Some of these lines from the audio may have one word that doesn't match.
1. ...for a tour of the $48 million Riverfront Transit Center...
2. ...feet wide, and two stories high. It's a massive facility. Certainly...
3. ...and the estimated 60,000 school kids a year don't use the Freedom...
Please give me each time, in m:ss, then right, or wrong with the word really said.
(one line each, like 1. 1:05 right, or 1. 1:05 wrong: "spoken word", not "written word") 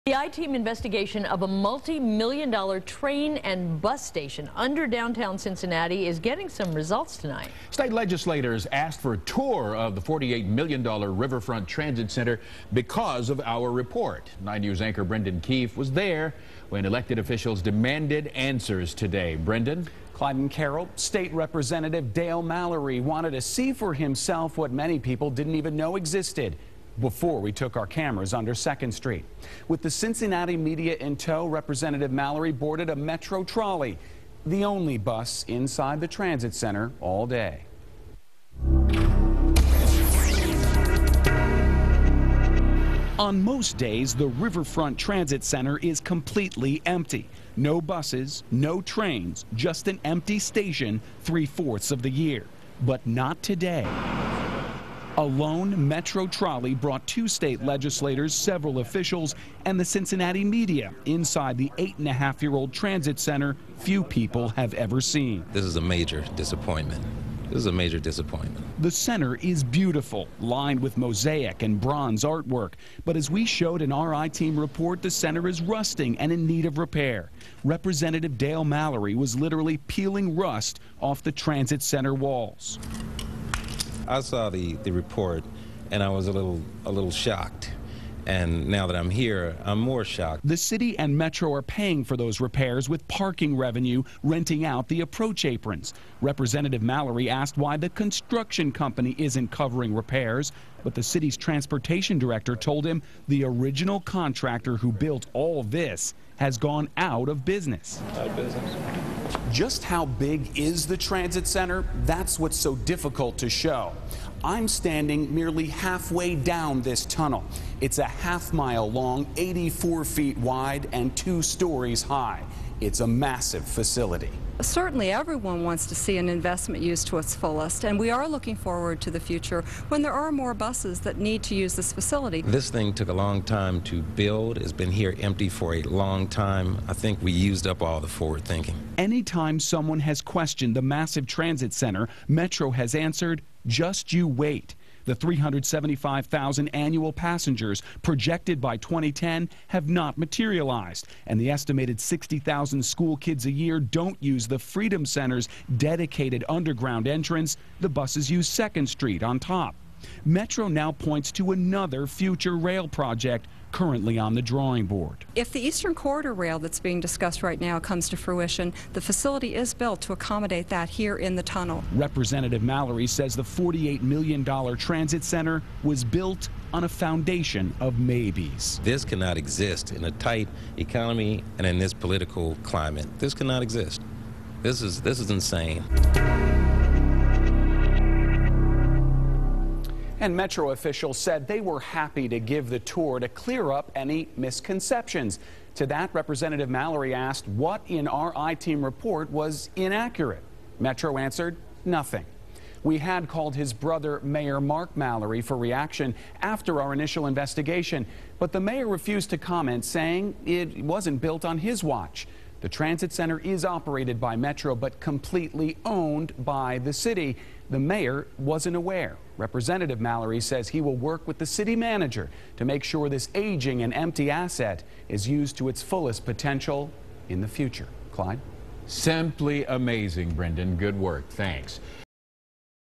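1. 0:08 right
2. 2:00 right
3. 2:31 right.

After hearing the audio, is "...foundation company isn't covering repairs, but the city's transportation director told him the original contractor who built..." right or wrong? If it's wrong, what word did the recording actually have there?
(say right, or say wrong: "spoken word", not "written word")
wrong: "construction", not "foundation".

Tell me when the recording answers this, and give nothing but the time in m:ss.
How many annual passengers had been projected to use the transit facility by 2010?
2:25.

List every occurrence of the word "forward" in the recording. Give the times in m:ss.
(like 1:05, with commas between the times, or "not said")
2:08, 2:18.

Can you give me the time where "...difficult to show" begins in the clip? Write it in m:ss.
1:52.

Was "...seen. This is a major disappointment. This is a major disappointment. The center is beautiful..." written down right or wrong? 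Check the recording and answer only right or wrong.
right.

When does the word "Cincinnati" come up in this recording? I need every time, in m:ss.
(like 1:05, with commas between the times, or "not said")
0:05, 0:29, 0:59.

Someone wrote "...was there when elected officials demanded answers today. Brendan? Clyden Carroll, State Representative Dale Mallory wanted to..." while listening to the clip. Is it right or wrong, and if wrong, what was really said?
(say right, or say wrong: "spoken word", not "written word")
right.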